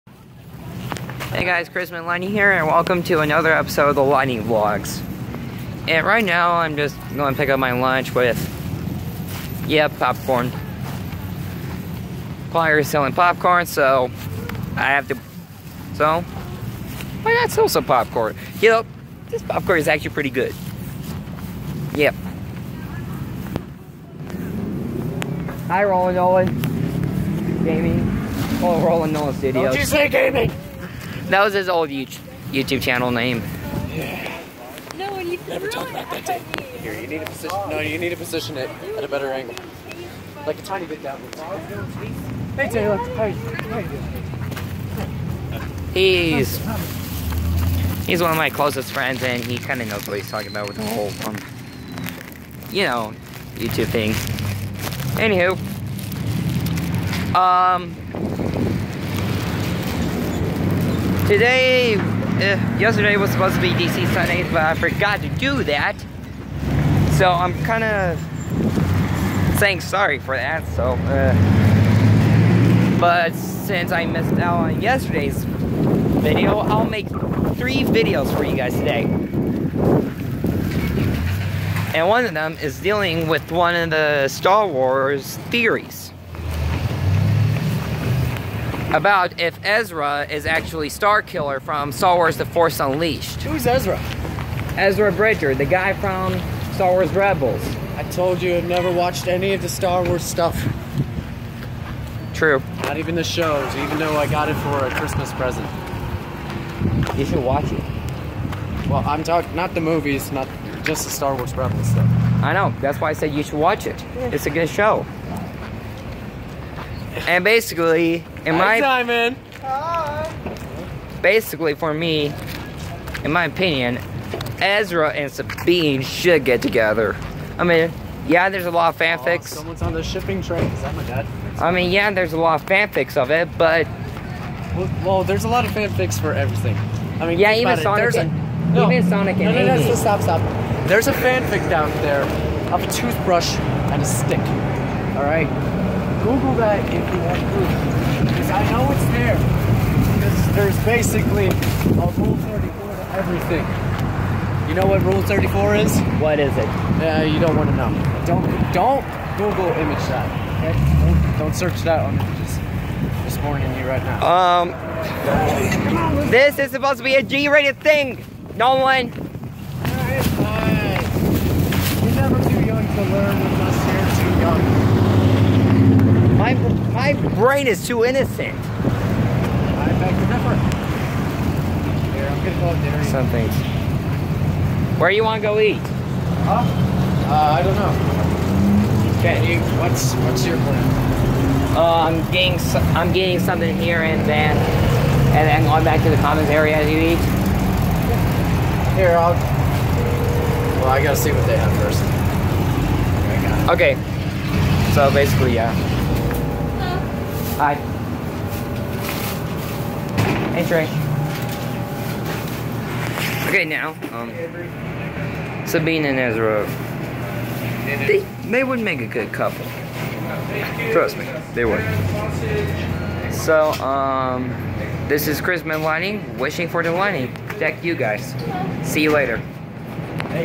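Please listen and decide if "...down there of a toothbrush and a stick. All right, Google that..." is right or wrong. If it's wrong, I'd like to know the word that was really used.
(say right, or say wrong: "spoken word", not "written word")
right.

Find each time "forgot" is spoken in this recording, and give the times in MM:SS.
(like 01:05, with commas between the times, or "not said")
01:04.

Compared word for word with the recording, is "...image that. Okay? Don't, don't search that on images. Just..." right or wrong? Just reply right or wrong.
right.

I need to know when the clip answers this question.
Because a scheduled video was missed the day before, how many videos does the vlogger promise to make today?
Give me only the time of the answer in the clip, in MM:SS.
01:17.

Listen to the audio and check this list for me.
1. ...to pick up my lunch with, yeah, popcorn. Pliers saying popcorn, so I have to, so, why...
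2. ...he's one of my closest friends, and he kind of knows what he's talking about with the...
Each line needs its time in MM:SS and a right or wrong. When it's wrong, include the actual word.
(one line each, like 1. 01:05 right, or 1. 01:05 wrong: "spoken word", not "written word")
1. 00:07 wrong: "selling", not "saying"
2. 00:48 right.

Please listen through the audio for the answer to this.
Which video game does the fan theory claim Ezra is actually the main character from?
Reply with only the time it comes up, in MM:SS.
01:31.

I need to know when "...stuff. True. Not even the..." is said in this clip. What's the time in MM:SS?
01:40.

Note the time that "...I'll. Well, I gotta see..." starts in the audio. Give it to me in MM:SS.
03:19.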